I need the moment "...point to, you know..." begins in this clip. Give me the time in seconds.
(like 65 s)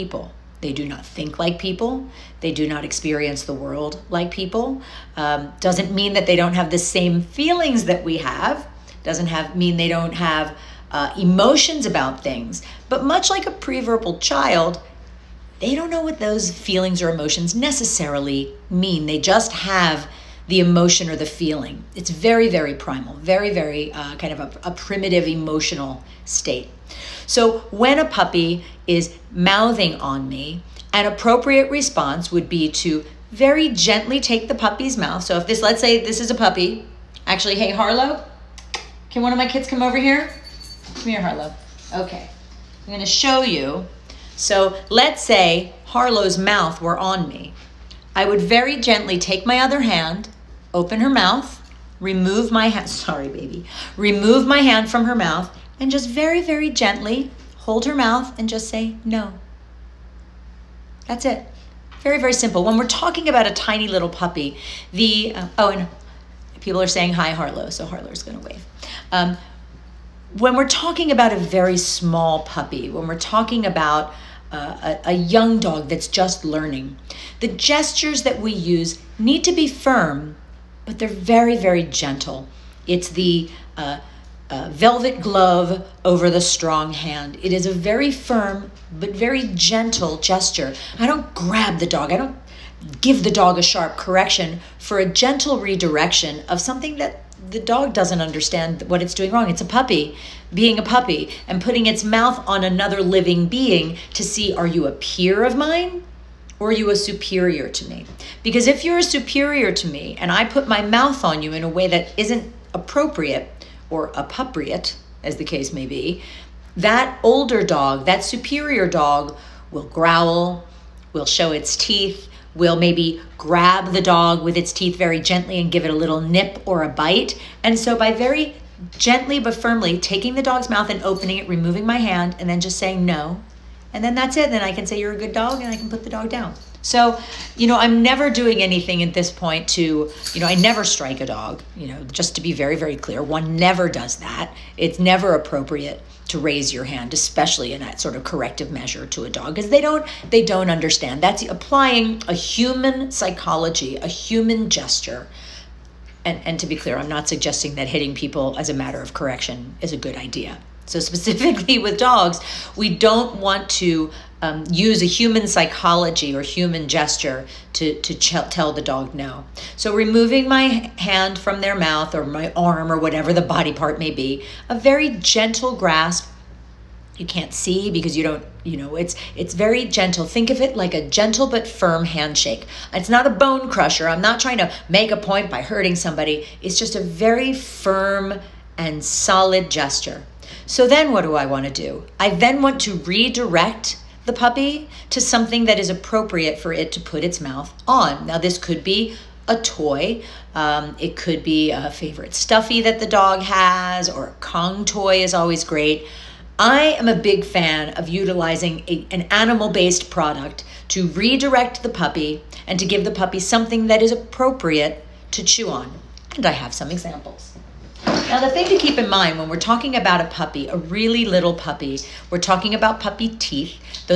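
139 s.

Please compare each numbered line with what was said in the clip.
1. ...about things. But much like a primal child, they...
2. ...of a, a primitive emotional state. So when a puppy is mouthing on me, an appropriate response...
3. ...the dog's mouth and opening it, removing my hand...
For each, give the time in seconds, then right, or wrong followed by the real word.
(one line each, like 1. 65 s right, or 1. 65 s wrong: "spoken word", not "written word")
1. 11 s wrong: "preverbal", not "primal"
2. 24 s right
3. 130 s right.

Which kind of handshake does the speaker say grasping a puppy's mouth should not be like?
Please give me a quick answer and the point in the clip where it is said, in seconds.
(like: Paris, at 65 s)
bone crusher, at 183 s.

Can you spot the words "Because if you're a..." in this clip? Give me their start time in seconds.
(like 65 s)
108 s.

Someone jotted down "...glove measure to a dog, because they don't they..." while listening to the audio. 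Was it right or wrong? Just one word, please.
wrong.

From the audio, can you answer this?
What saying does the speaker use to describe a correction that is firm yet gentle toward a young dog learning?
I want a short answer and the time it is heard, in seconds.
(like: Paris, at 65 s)
velvet glove over the strong hand, at 84 s.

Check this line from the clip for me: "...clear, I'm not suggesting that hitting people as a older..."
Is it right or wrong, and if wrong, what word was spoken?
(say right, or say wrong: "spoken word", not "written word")
wrong: "matter", not "older".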